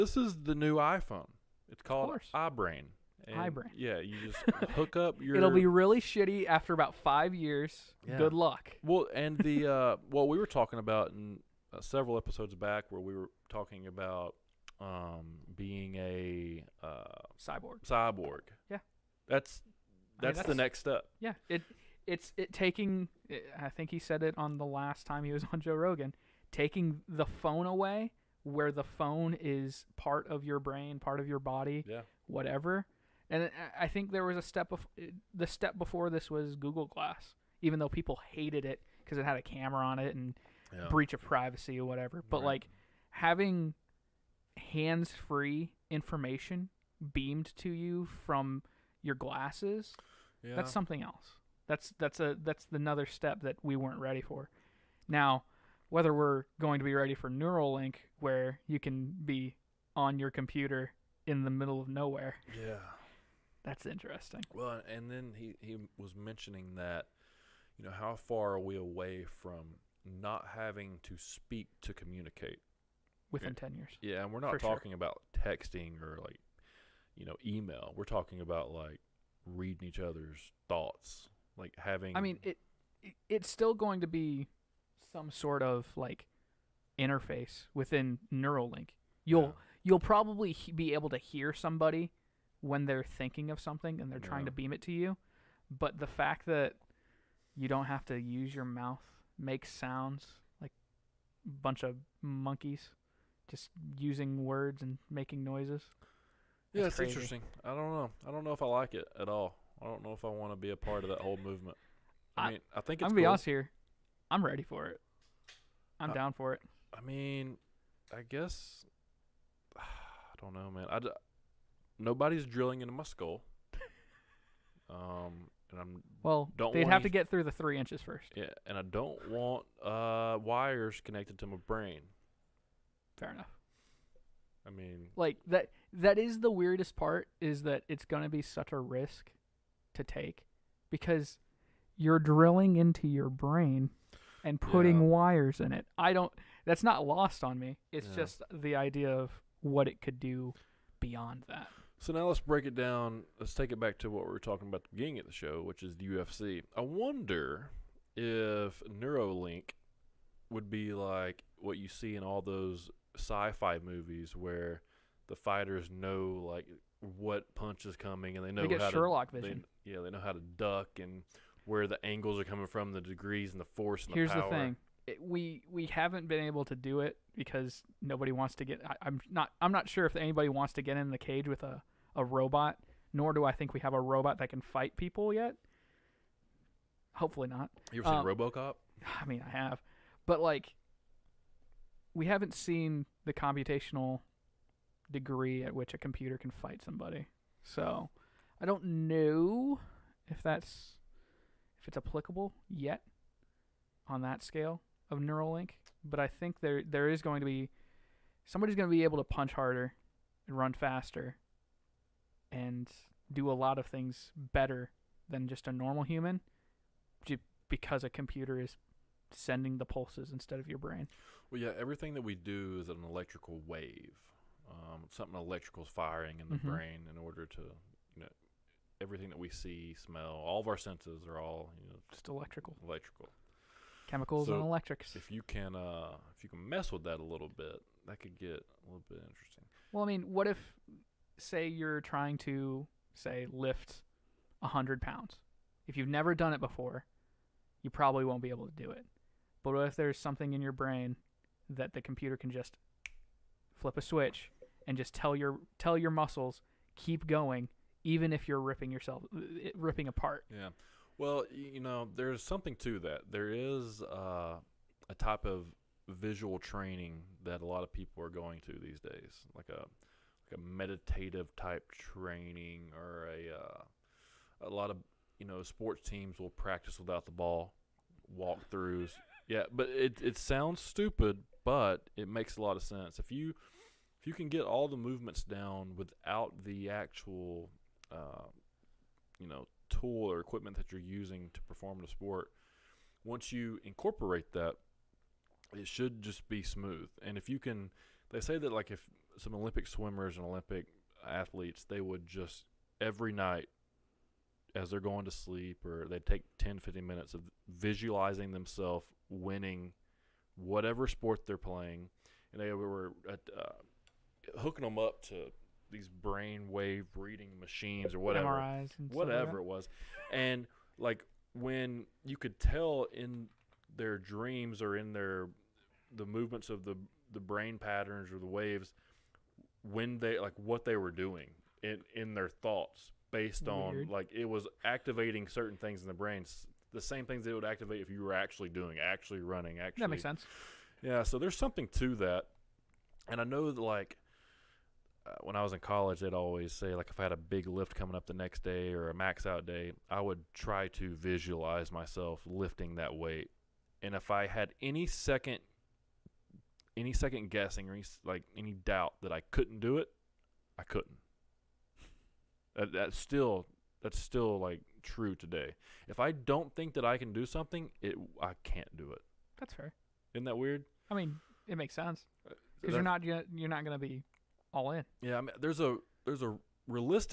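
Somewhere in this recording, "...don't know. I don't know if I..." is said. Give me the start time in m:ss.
1:47.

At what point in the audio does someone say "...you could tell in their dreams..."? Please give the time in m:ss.
5:22.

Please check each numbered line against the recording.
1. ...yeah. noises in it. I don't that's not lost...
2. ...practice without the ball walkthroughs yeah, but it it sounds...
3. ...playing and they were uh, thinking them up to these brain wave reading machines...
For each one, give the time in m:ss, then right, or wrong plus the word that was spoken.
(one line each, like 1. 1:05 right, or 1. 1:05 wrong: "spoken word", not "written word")
1. 2:25 wrong: "wires", not "noises"
2. 4:36 right
3. 5:11 wrong: "hooking", not "thinking".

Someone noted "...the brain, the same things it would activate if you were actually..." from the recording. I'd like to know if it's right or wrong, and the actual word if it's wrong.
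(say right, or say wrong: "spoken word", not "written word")
right.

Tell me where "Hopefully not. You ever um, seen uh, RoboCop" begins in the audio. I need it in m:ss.
3:07.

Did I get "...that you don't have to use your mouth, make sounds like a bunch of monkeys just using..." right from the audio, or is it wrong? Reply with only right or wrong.
right.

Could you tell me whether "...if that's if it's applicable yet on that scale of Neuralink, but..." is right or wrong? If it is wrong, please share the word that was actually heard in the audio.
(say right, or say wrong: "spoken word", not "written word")
right.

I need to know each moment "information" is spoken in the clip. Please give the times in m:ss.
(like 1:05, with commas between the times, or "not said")
0:45.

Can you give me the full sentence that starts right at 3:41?
Well, yeah, everything that we do is an electrical wave.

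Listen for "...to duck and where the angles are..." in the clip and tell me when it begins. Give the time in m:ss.
2:50.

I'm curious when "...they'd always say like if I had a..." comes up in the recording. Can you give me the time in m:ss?
5:46.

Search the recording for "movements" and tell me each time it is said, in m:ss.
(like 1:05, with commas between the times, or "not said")
1:51, 4:44, 5:26.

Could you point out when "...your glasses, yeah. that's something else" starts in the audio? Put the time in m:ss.
0:49.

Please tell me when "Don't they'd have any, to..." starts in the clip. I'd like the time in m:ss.
2:06.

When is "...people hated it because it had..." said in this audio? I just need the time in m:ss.
0:37.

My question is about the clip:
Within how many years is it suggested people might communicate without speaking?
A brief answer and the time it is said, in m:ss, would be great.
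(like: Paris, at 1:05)
10 years, at 1:13.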